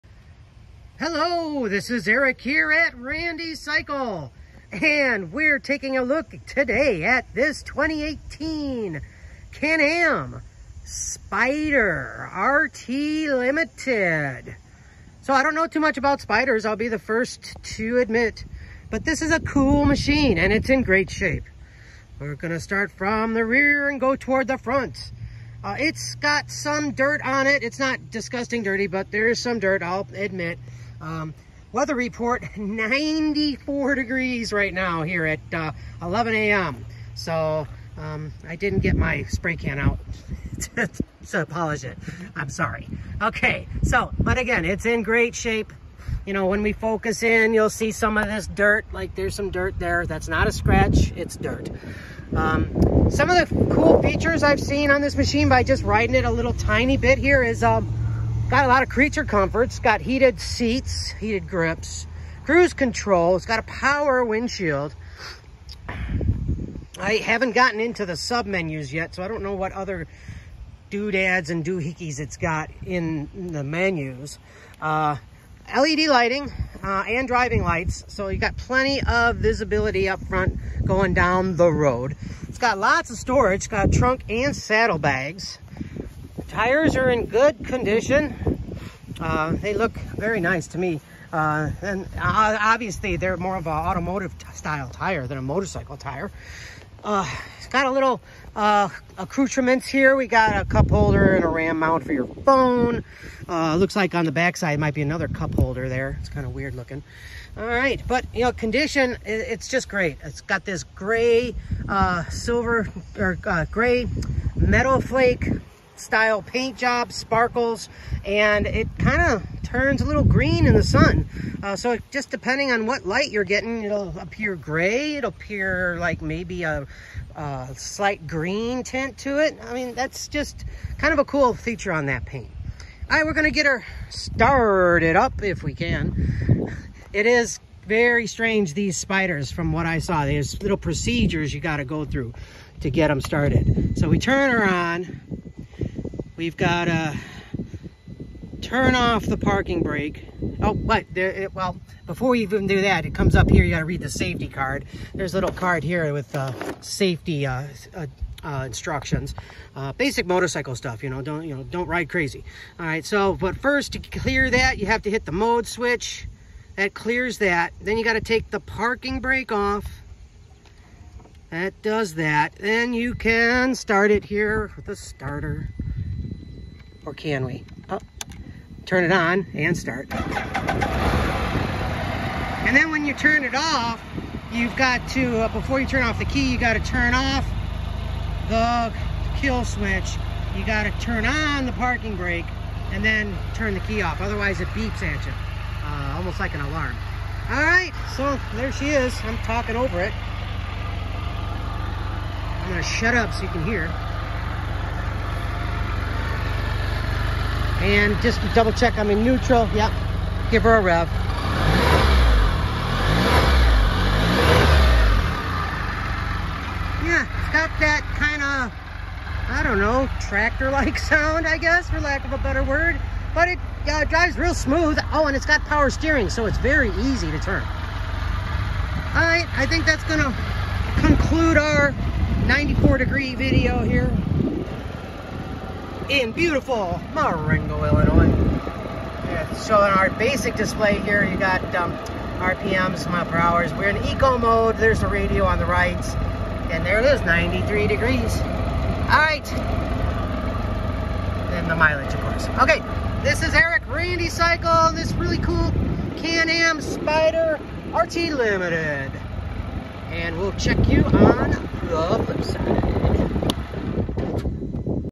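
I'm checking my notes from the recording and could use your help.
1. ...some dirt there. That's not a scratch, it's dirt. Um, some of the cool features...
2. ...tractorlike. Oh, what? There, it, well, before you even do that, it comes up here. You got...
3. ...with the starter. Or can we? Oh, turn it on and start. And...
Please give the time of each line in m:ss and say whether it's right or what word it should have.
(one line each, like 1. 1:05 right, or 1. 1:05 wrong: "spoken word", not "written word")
1. 0:49 right
2. 2:29 wrong: "brake", not "tractorlike"
3. 2:54 right.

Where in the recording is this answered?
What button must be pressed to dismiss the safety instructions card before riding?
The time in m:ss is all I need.
2:45.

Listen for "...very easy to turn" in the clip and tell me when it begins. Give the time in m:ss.
3:46.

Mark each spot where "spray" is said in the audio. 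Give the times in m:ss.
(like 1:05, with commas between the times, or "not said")
0:39.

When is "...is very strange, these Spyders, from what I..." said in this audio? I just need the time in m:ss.
2:17.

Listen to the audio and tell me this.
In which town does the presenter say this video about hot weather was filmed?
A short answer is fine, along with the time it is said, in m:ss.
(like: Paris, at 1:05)
Marengo, Illinois, at 3:57.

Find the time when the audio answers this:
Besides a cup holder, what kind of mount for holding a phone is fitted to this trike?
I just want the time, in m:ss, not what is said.
1:41.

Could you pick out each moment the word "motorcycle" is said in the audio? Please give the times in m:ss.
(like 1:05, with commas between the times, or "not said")
1:35, 2:40.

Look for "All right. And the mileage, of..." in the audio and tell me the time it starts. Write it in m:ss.
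4:08.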